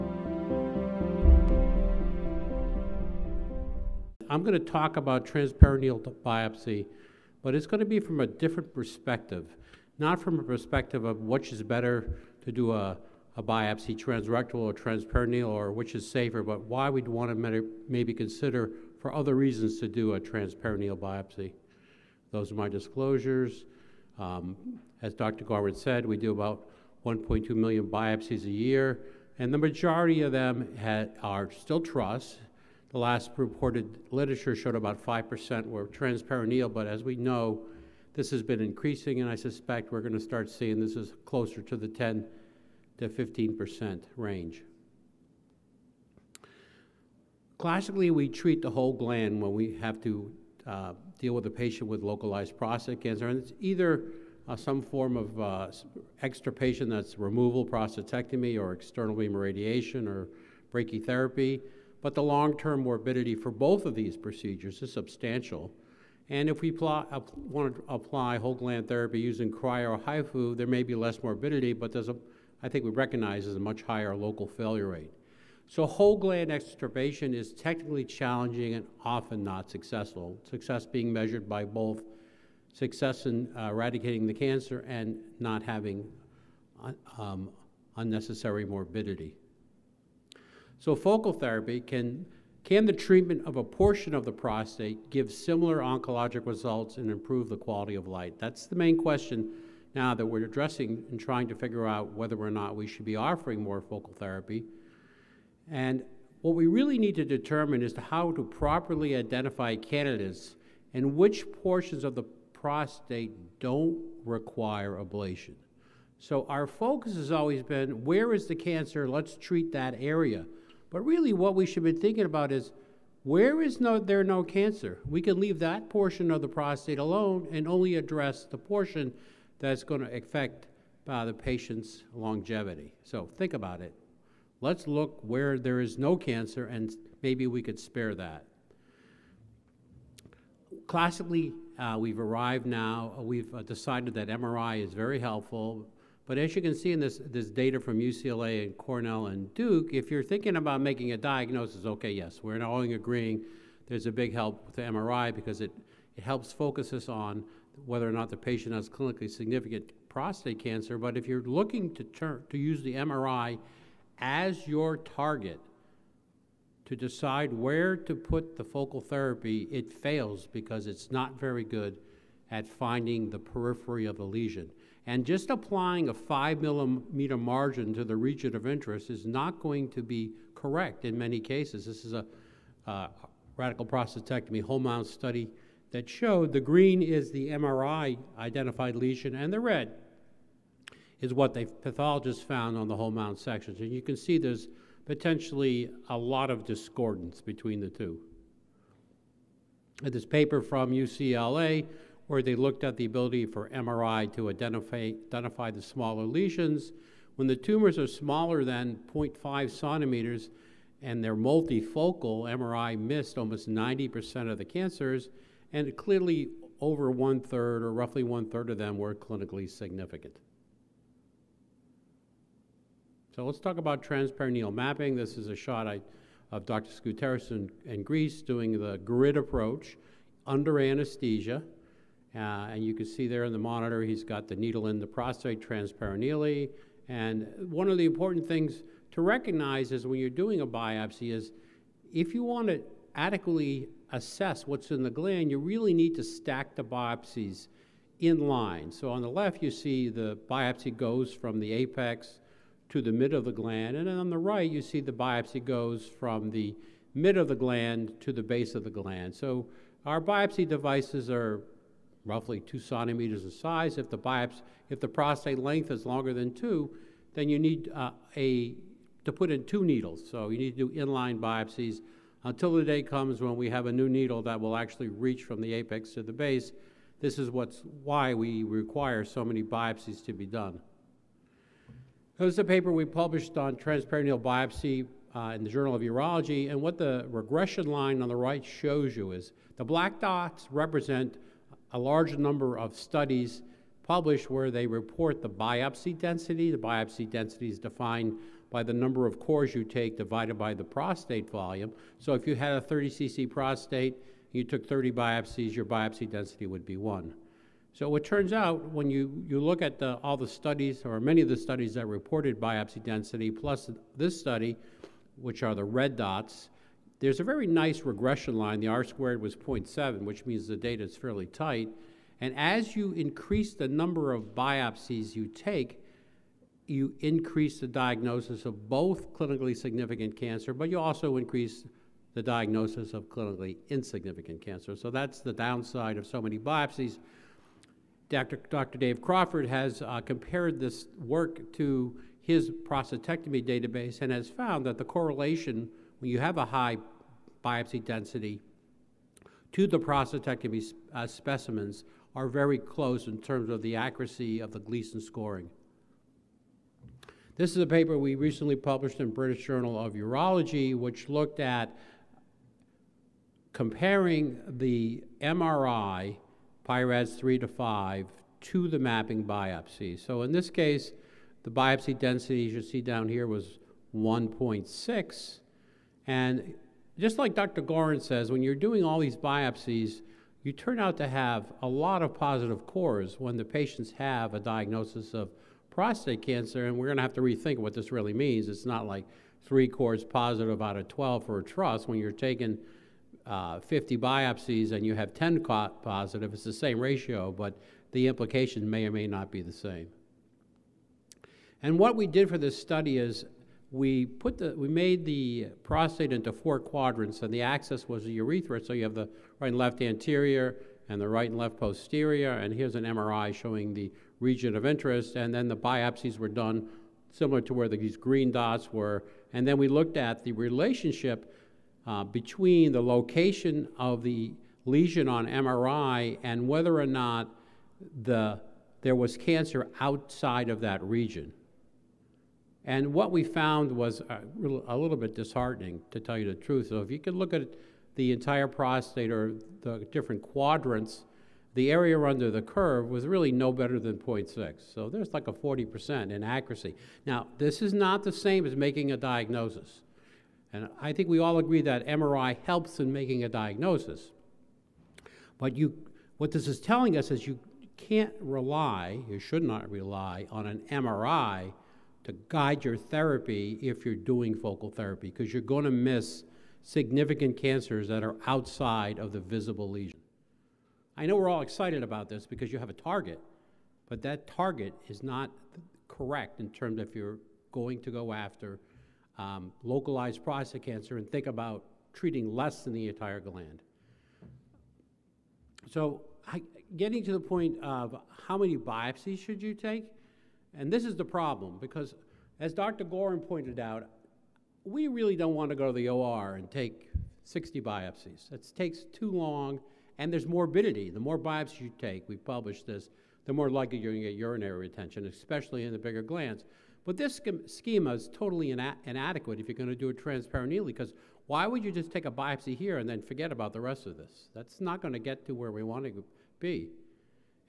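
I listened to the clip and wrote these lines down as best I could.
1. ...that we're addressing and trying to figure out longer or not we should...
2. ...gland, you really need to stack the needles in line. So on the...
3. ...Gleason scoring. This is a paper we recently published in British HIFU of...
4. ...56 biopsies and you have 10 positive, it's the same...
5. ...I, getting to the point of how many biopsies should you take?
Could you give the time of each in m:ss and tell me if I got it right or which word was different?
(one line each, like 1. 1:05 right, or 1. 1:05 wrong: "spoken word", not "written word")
1. 1:40 wrong: "whether", not "longer"
2. 4:05 wrong: "biopsies", not "needles"
3. 5:54 wrong: "Journal", not "HIFU"
4. 6:33 wrong: "50", not "56"
5. 8:06 right.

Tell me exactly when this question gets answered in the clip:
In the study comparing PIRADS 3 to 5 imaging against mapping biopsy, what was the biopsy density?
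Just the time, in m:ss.
6:14.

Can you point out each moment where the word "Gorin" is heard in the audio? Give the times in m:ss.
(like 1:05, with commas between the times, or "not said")
6:17, 8:13.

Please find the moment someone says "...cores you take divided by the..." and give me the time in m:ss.
4:59.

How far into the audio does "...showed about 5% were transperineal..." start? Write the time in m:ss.
0:34.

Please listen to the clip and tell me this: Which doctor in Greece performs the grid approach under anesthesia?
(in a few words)
Dr. Skouteris.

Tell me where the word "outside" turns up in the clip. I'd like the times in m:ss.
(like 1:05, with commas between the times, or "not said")
7:10, 7:48.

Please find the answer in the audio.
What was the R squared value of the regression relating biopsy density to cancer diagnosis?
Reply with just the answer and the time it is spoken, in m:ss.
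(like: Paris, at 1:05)
0.7, at 5:19.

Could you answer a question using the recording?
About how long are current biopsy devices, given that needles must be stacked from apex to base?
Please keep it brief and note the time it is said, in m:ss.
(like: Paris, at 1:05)
2 centimeters, at 4:22.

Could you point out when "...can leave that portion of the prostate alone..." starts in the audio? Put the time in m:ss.
2:05.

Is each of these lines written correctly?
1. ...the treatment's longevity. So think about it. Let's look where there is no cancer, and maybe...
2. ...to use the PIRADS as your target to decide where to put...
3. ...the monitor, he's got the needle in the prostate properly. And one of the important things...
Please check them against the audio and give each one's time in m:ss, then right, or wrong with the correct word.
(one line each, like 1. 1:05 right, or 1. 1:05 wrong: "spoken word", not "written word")
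1. 2:11 wrong: "patient", not "treatment"
2. 2:42 wrong: "MRI", not "PIRADS"
3. 3:53 wrong: "transperineally", not "properly".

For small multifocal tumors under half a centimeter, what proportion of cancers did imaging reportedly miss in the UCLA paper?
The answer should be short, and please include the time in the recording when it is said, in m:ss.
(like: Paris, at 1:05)
almost 90%, at 3:33.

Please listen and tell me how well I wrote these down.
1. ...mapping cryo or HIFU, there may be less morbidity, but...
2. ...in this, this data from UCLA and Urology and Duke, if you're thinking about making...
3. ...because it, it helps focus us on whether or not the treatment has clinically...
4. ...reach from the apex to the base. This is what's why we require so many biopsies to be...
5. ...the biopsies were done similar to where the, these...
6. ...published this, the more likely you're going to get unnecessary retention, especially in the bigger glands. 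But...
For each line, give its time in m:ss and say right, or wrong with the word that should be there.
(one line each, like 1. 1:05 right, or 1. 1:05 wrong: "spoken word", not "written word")
1. 1:09 wrong: "using", not "mapping"
2. 2:26 wrong: "Cornell", not "Urology"
3. 2:35 wrong: "patient", not "treatment"
4. 4:35 right
5. 6:55 right
6. 8:22 wrong: "urinary", not "unnecessary".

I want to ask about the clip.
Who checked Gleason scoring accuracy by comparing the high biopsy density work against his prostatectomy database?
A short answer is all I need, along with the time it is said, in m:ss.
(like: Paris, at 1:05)
Dave Crawford, at 5:38.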